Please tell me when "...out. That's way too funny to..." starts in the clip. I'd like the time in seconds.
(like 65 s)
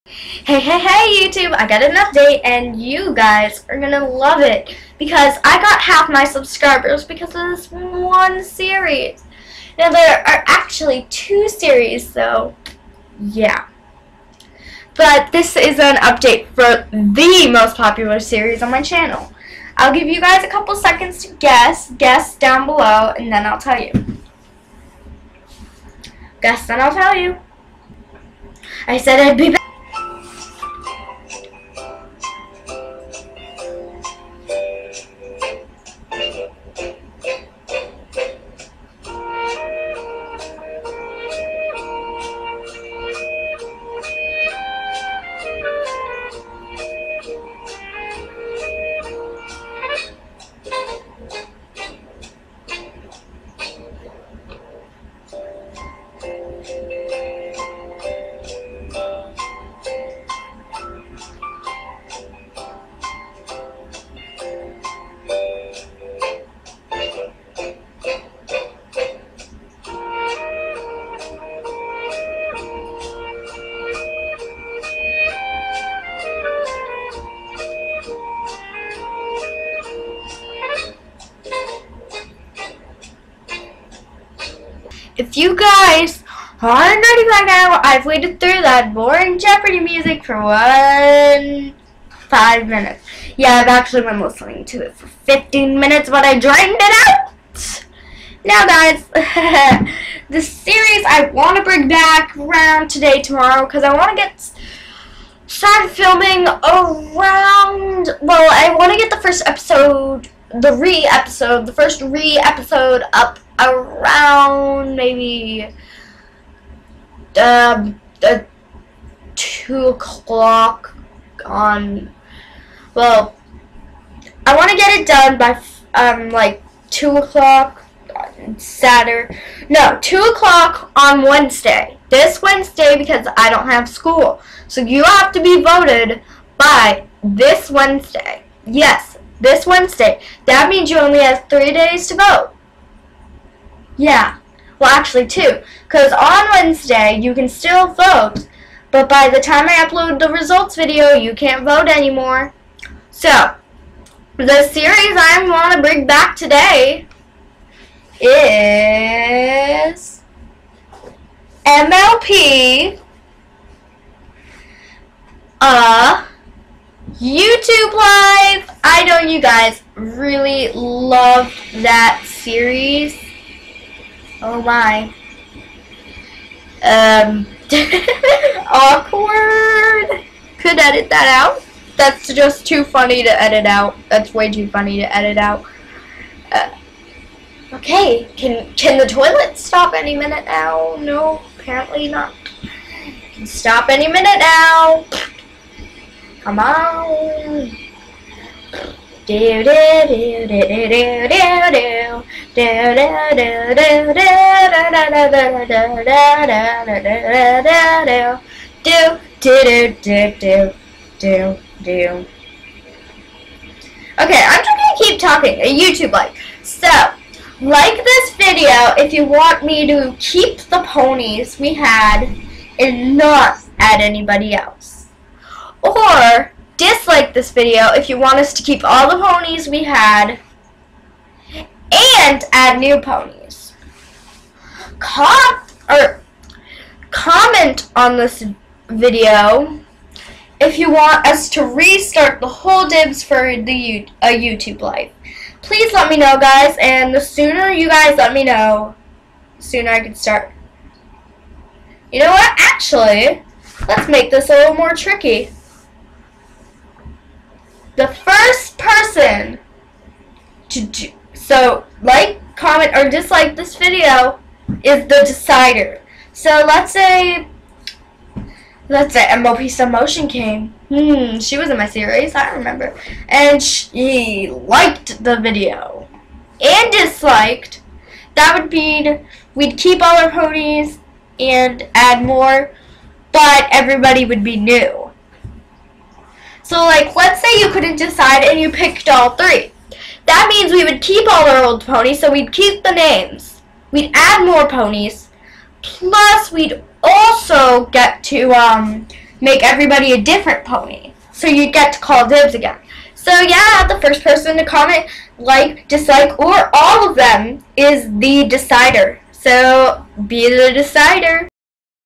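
183 s.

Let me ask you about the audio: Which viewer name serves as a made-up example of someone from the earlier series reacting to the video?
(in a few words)
Some Motion.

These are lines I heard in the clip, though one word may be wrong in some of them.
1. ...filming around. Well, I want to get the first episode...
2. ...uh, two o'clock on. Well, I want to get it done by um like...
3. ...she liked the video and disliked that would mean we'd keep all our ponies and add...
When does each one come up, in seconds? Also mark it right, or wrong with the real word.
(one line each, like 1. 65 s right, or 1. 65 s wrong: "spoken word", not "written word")
1. 105 s right
2. 118 s right
3. 273 s right.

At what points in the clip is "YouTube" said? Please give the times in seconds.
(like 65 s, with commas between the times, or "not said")
1 s, 167 s, 244 s.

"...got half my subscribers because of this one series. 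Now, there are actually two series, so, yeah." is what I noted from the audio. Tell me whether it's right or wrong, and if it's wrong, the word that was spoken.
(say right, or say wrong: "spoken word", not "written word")
right.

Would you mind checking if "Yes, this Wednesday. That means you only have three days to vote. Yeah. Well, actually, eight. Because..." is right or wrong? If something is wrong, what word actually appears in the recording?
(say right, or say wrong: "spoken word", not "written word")
wrong: "two", not "eight".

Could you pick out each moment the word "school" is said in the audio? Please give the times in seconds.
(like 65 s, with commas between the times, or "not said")
133 s.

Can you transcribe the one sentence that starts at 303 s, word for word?
So yeah, the first person to comment, like, dislike, or all of them is the decider.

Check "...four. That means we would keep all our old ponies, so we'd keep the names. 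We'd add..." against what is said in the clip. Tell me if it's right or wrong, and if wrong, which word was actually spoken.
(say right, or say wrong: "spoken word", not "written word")
wrong: "three", not "four".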